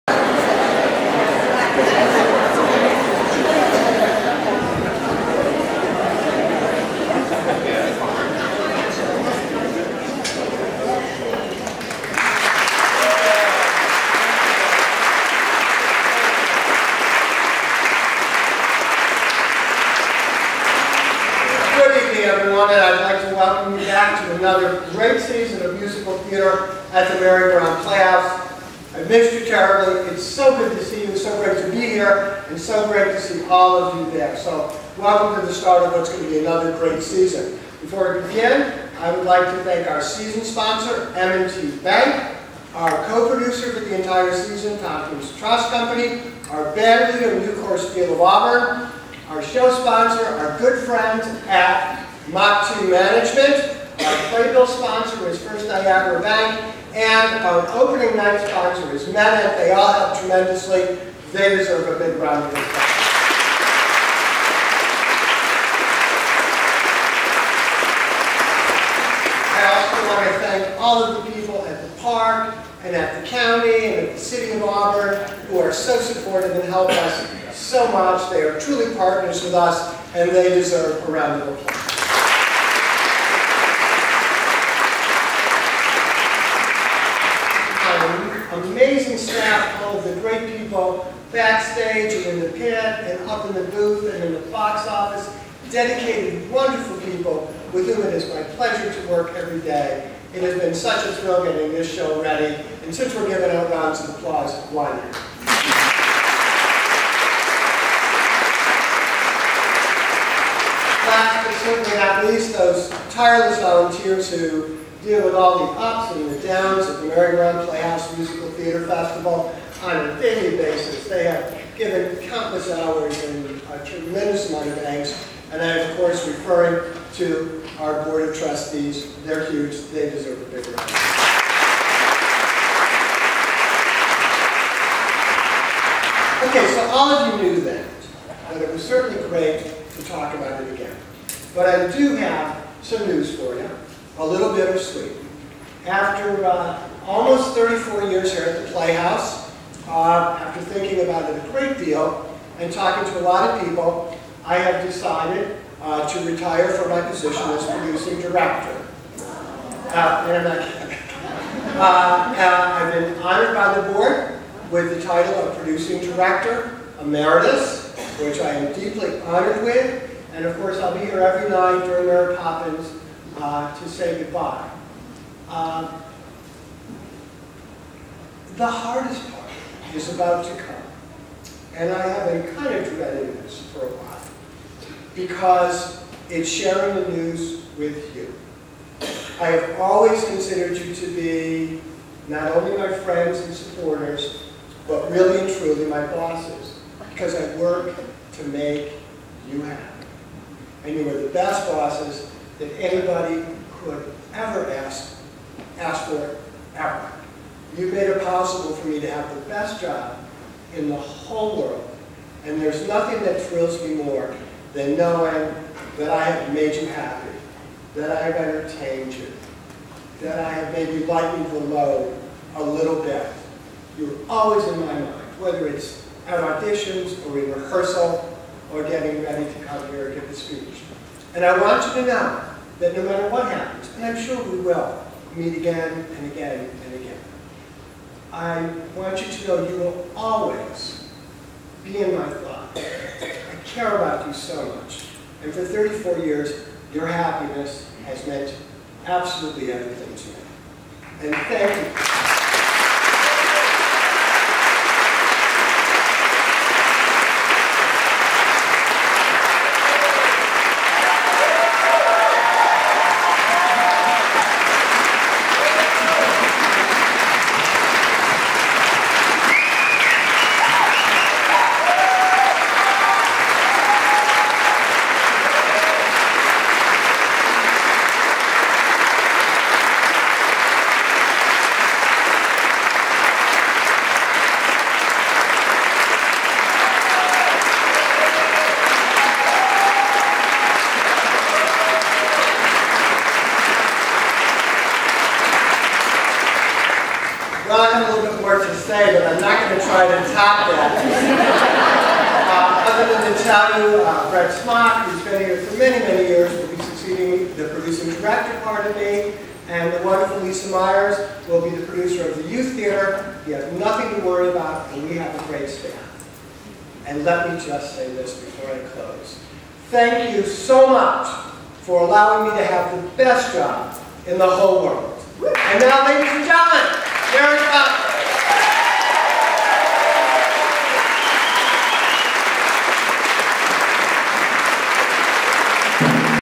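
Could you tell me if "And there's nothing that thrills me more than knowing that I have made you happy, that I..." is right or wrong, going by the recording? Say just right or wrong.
right.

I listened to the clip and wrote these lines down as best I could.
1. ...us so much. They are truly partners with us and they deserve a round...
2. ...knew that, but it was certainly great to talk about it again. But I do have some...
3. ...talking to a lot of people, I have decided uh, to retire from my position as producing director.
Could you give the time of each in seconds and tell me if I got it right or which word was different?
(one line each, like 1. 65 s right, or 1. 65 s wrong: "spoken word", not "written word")
1. 76 s right
2. 137 s right
3. 152 s right.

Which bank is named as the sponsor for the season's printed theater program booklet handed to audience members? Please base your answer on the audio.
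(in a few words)
First Niagara Bank.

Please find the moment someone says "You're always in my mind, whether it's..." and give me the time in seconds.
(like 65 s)
223 s.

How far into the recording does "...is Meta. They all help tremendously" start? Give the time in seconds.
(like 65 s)
58 s.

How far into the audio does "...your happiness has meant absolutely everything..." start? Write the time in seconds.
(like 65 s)
246 s.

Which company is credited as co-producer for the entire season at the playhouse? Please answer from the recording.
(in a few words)
Tompkins Trust Company.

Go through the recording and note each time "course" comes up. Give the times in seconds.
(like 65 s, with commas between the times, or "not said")
125 s, 170 s.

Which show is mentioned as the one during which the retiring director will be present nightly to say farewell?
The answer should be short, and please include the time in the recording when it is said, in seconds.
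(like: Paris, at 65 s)
Mary Poppins, at 172 s.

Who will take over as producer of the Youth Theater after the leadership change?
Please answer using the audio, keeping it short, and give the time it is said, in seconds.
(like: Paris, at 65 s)
Lisa Myers, at 310 s.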